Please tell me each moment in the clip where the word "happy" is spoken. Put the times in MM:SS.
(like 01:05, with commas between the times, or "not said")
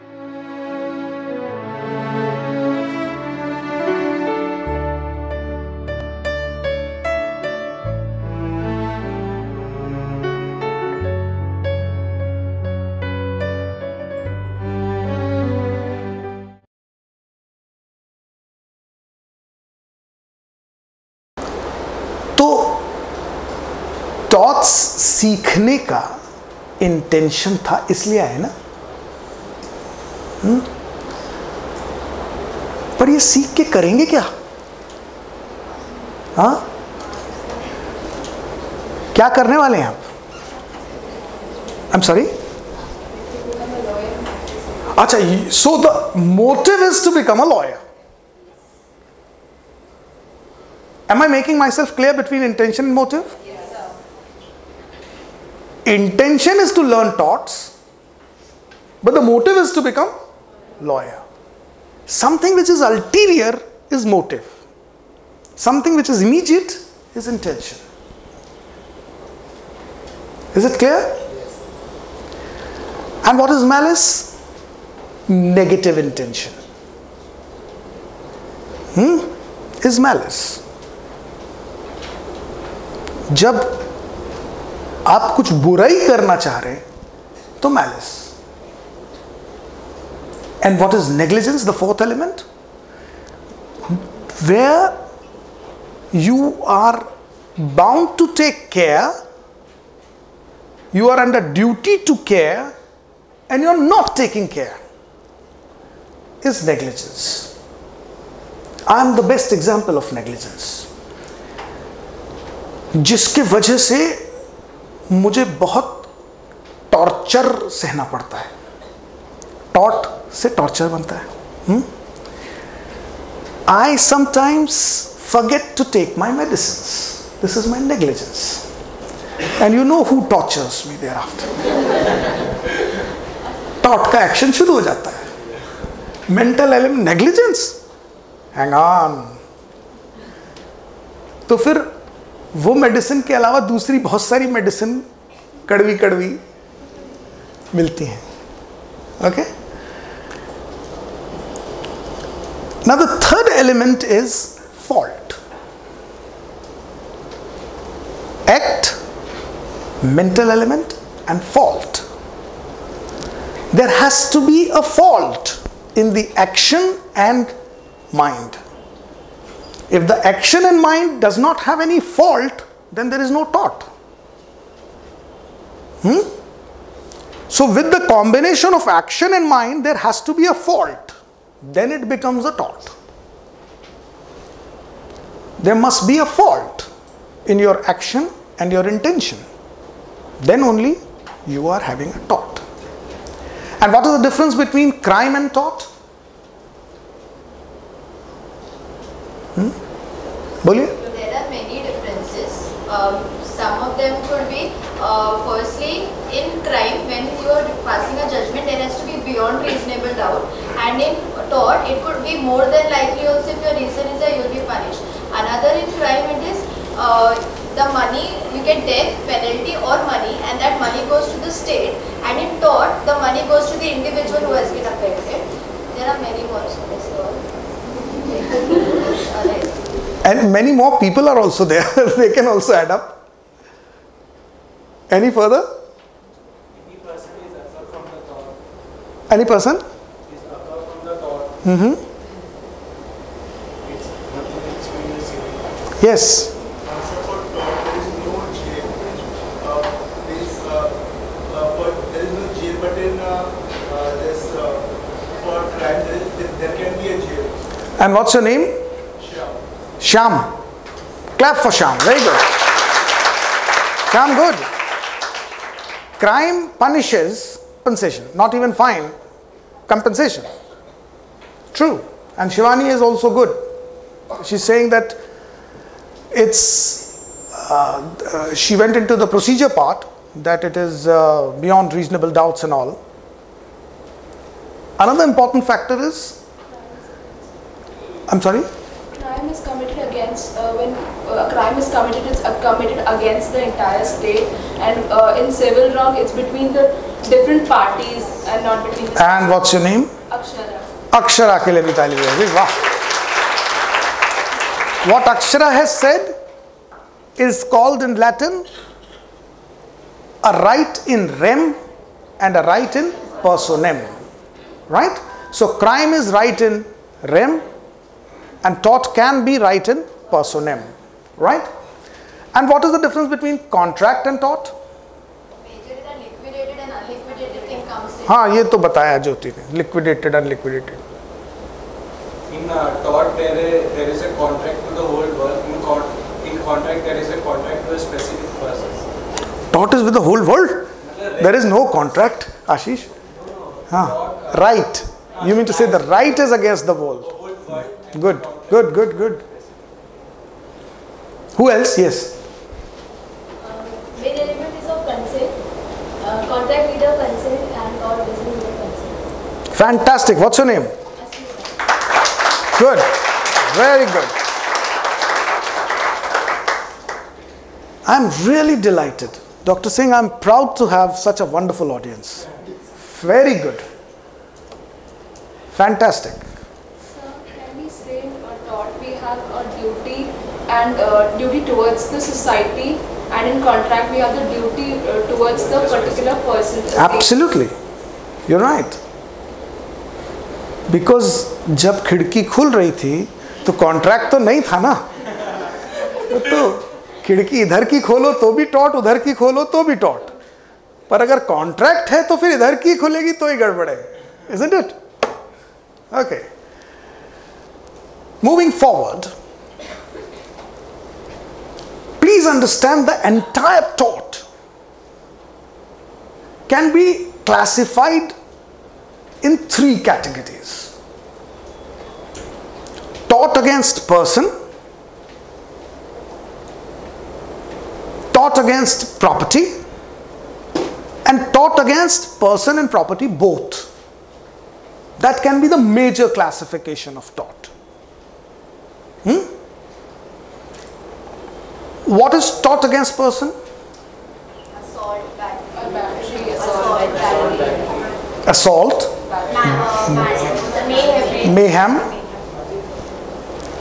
not said.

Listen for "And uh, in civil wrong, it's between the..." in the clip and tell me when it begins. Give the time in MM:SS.
04:54.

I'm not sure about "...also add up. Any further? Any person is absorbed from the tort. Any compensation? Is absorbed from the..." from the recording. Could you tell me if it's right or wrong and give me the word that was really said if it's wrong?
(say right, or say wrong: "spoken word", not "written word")
wrong: "person", not "compensation".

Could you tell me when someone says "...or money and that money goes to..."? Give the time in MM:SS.
03:39.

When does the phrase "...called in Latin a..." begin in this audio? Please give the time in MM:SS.
05:07.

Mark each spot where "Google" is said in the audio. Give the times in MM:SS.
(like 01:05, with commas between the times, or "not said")
not said.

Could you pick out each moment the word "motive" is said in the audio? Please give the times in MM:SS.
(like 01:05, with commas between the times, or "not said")
00:59, 01:04.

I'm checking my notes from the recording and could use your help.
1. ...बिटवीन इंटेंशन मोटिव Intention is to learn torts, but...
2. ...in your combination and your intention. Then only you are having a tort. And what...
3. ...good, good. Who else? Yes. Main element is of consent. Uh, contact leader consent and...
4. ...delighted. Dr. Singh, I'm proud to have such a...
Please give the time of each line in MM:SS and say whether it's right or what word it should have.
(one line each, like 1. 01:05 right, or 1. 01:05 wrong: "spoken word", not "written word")
1. 00:52 right
2. 03:07 wrong: "action", not "combination"
3. 05:48 right
4. 06:08 right.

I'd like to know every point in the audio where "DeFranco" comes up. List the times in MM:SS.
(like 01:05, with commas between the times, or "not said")
not said.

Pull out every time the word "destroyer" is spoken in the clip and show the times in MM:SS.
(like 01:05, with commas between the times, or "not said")
not said.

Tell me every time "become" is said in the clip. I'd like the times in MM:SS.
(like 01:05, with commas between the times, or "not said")
00:59, 03:02.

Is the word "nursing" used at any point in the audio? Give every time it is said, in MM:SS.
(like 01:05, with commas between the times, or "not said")
not said.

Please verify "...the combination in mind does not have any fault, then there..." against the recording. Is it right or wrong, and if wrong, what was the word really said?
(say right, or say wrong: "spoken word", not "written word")
wrong: "action", not "combination".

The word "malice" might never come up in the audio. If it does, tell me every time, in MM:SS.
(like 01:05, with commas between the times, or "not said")
01:13, 01:19.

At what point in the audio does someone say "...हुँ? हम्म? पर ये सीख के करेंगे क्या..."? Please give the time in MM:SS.
00:30.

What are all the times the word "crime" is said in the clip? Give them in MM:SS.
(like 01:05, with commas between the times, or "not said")
03:15, 03:26, 03:35, 04:26, 04:51, 05:15.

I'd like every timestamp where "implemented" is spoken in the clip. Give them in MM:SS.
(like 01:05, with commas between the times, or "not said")
not said.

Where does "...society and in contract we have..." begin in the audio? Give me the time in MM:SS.
06:22.